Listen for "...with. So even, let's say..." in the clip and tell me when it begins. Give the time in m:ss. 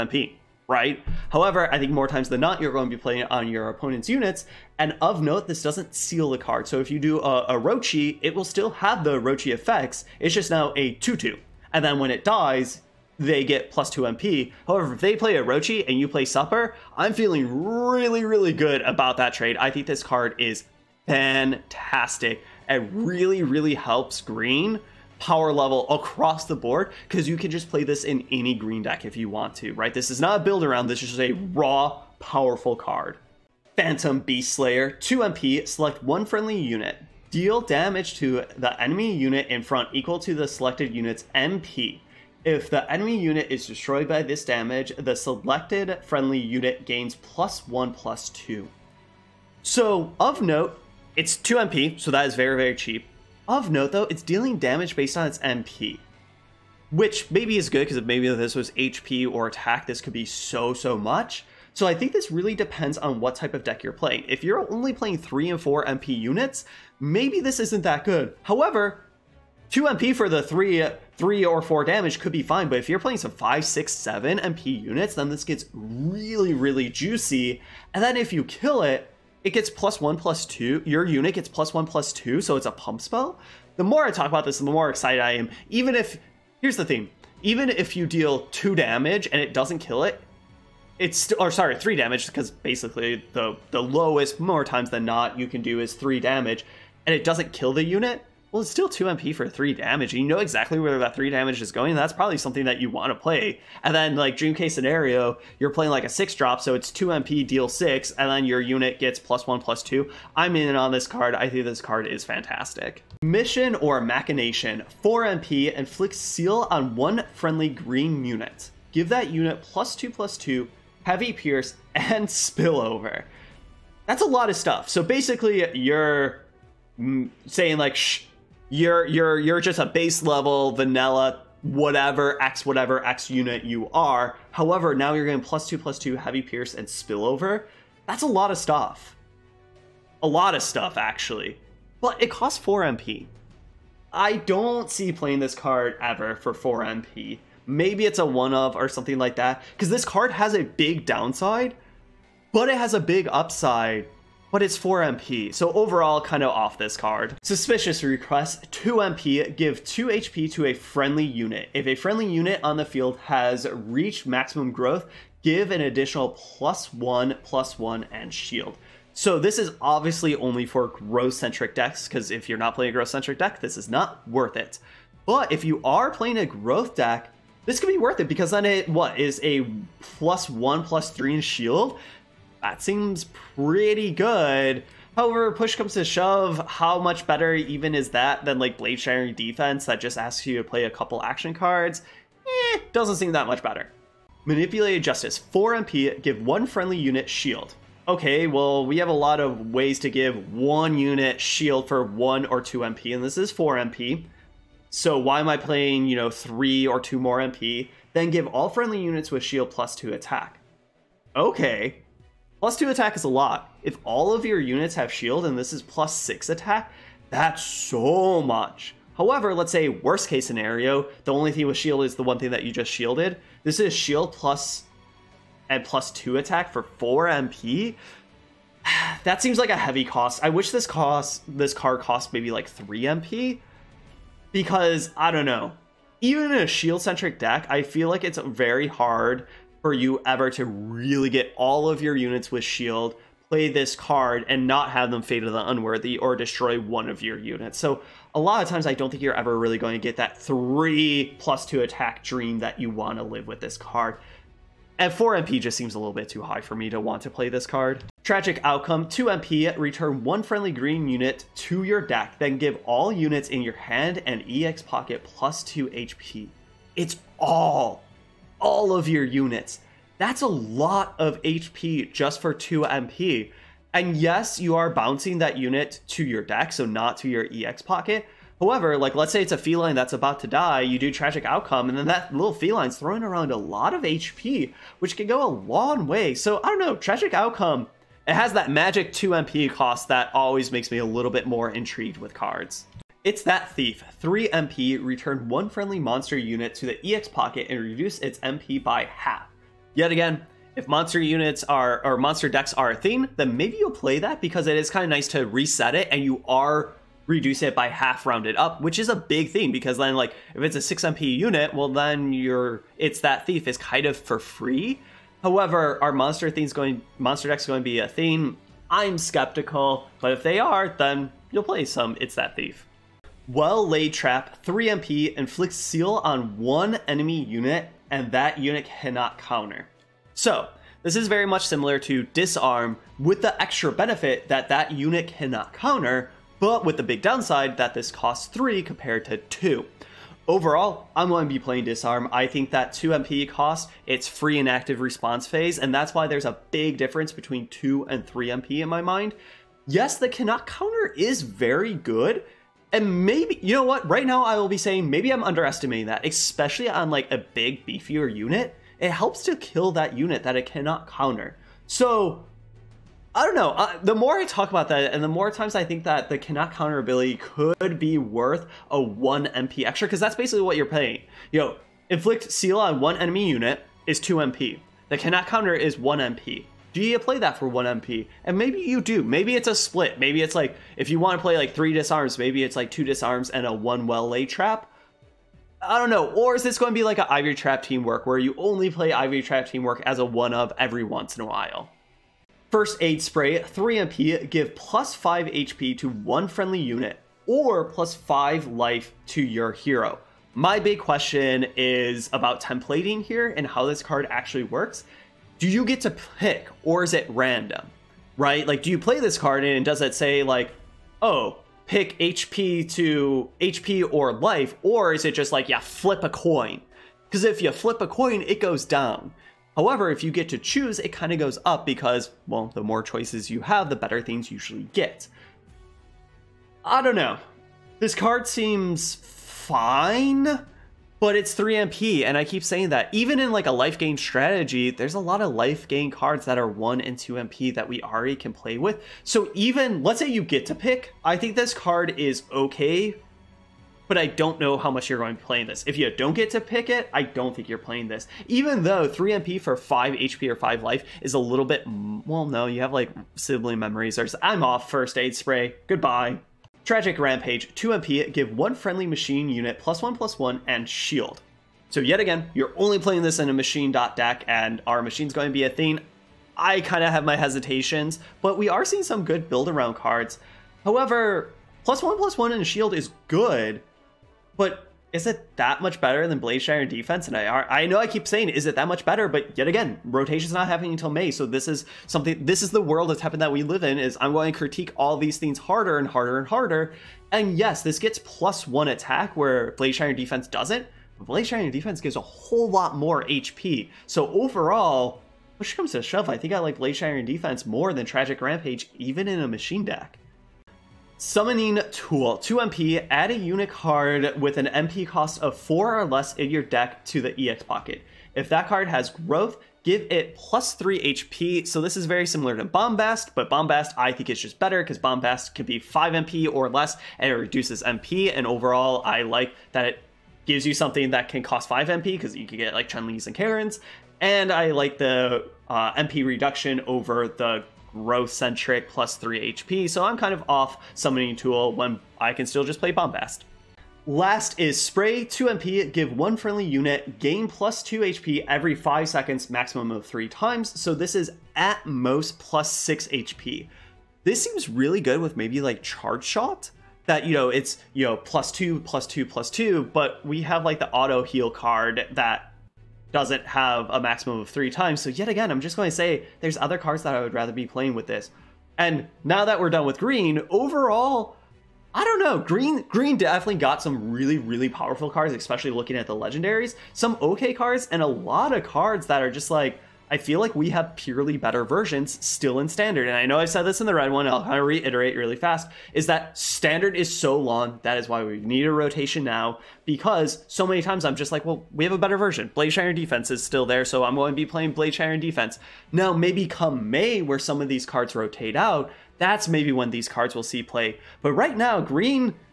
7:18.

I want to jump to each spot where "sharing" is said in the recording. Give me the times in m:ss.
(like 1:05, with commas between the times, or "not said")
3:08.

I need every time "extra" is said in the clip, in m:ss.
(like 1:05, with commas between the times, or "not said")
5:33, 6:09.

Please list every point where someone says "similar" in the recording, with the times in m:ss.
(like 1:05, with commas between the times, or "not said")
5:31, 8:32.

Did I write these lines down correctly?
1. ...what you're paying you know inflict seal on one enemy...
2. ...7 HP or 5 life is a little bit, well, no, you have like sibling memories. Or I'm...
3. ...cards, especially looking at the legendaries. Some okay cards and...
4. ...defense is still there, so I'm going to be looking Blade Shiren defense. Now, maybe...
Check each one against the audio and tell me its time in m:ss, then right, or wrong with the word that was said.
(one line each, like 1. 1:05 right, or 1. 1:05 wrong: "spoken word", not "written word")
1. 6:10 right
2. 7:29 wrong: "5", not "7"
3. 9:25 right
4. 9:42 wrong: "playing", not "looking".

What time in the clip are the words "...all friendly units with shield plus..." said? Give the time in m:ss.
3:28.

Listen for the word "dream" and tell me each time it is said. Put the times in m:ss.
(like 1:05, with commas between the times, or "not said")
1:44, 4:12.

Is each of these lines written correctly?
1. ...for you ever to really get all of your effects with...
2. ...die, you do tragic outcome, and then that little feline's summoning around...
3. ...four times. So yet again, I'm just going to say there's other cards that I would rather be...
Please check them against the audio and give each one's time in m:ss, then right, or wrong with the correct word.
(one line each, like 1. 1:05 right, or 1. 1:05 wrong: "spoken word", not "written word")
1. 3:59 wrong: "units", not "effects"
2. 4:40 wrong: "throwing", not "summoning"
3. 9:14 wrong: "three", not "four".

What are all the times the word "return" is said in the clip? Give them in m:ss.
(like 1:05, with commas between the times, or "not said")
4:19, 4:55.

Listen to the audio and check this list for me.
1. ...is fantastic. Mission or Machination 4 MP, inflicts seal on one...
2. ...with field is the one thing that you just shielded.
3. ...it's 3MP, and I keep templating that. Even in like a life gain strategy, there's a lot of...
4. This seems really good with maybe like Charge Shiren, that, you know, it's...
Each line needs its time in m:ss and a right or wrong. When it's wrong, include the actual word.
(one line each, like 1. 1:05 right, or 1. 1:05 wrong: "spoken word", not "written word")
1. 1:52 right
2. 3:41 wrong: "shield", not "field"
3. 7:11 wrong: "saying", not "templating"
4. 9:04 wrong: "Shot", not "Shiren".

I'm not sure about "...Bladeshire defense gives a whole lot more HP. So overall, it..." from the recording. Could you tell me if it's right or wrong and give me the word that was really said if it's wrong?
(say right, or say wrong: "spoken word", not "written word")
right.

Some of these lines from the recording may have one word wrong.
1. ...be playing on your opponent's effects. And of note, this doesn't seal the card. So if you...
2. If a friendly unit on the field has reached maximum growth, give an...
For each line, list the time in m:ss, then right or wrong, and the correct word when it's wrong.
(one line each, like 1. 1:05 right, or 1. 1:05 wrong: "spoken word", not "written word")
1. 0:02 wrong: "units", not "effects"
2. 2:41 right.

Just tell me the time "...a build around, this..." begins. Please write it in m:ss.
0:30.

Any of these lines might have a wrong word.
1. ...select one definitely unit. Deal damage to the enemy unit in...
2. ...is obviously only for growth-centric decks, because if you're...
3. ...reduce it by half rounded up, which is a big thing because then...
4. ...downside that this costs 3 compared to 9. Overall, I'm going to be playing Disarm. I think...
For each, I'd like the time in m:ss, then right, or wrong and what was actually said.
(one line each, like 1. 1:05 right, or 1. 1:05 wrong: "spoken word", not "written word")
1. 0:35 wrong: "friendly", not "definitely"
2. 2:49 right
3. 5:07 right
4. 5:37 wrong: "2", not "9".